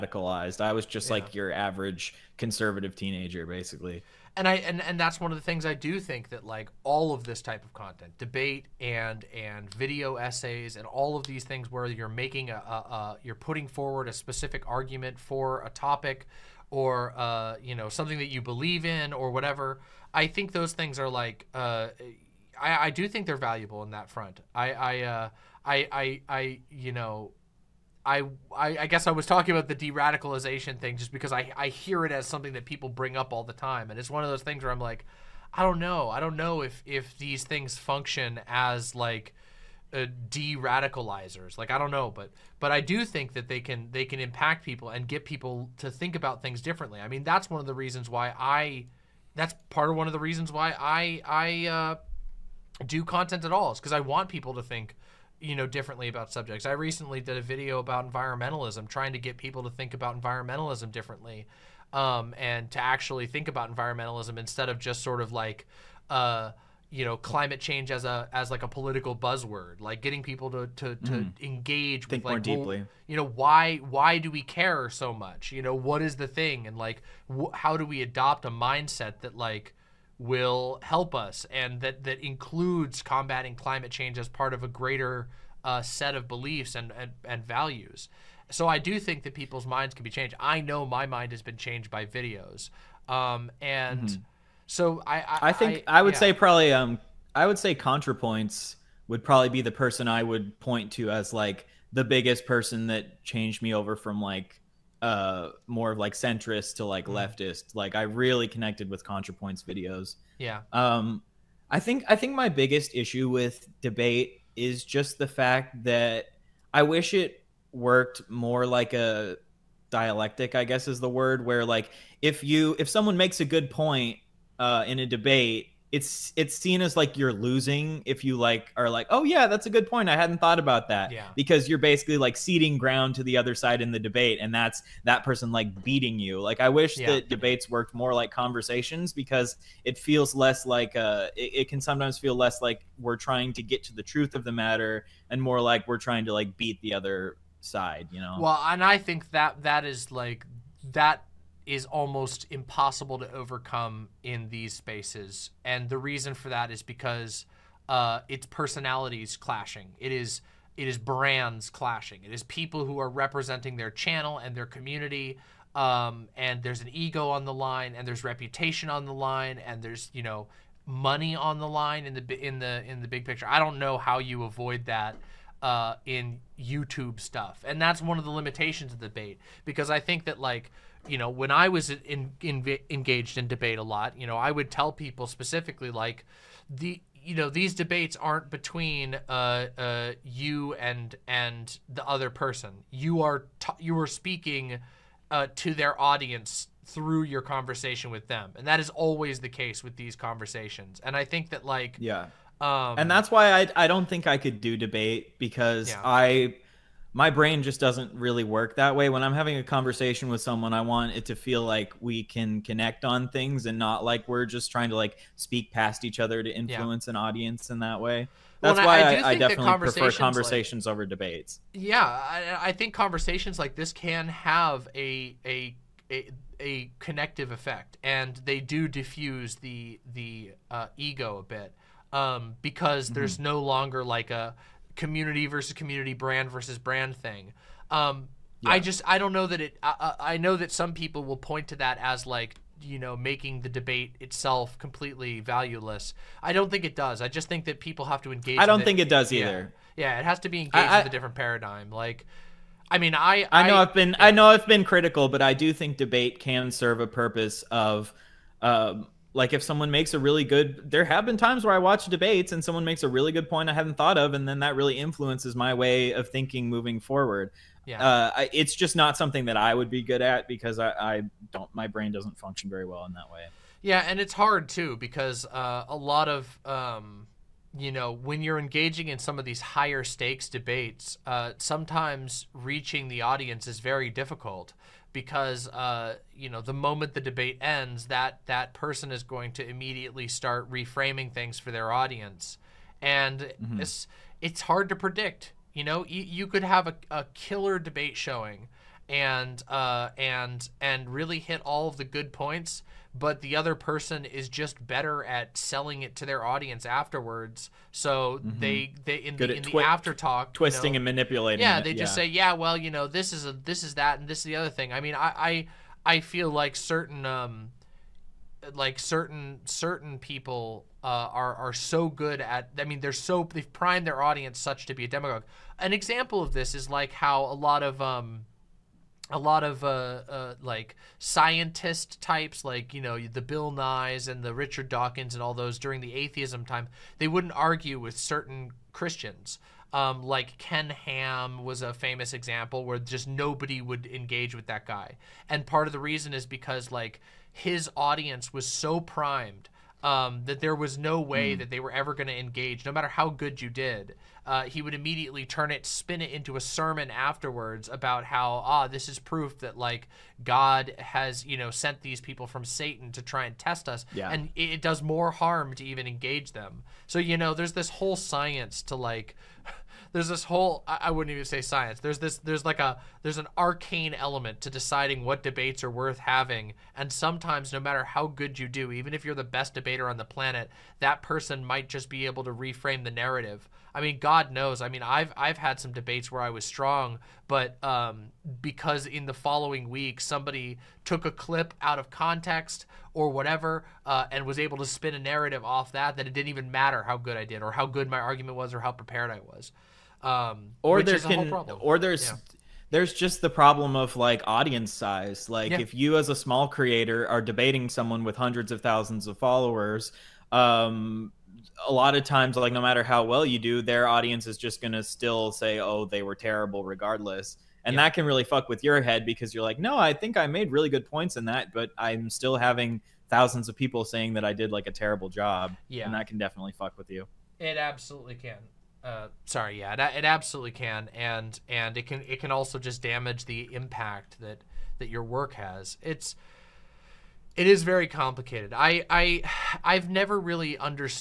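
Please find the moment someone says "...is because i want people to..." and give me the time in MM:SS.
00:53.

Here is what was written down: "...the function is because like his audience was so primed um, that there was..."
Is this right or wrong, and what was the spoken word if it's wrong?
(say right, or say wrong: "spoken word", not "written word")
wrong: "reason", not "function".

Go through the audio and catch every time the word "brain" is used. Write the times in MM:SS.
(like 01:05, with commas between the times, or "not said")
03:27, 04:31.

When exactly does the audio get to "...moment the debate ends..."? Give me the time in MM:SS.
04:46.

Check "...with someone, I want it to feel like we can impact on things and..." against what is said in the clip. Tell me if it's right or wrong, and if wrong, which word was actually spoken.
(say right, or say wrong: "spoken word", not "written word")
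wrong: "connect", not "impact".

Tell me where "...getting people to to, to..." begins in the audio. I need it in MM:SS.
01:10.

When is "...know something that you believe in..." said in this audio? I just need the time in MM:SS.
00:17.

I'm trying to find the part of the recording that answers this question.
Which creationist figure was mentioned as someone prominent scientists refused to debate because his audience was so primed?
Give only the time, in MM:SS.
05:40.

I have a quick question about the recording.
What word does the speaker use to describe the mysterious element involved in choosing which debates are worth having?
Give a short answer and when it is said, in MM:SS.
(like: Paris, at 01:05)
arcane, at 06:13.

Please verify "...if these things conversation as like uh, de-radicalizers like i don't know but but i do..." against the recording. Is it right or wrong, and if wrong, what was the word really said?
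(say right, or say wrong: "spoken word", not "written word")
wrong: "function", not "conversation".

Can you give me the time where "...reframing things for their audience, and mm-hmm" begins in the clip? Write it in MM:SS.
04:50.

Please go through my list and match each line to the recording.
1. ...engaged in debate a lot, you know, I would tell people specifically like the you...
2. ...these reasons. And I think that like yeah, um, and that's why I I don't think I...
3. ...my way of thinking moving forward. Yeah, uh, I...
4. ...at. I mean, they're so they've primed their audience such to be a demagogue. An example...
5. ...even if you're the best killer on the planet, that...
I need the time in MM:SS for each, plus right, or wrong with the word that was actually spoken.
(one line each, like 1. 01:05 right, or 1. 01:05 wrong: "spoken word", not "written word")
1. 03:02 right
2. 03:19 wrong: "conversations", not "reasons"
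3. 04:25 right
4. 05:22 right
5. 06:18 wrong: "debater", not "killer".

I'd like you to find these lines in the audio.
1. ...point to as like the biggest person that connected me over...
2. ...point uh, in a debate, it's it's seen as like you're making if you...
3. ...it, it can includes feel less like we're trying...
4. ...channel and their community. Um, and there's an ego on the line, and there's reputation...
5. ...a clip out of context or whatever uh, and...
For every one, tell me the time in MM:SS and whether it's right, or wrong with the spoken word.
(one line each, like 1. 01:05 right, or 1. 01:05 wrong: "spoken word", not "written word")
1. 01:40 wrong: "changed", not "connected"
2. 02:03 wrong: "losing", not "making"
3. 02:21 wrong: "sometimes", not "includes"
4. 02:43 right
5. 06:31 right.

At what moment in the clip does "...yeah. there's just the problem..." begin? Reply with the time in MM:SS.
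06:42.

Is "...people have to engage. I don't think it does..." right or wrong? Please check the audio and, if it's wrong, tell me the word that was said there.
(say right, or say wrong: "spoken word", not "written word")
right.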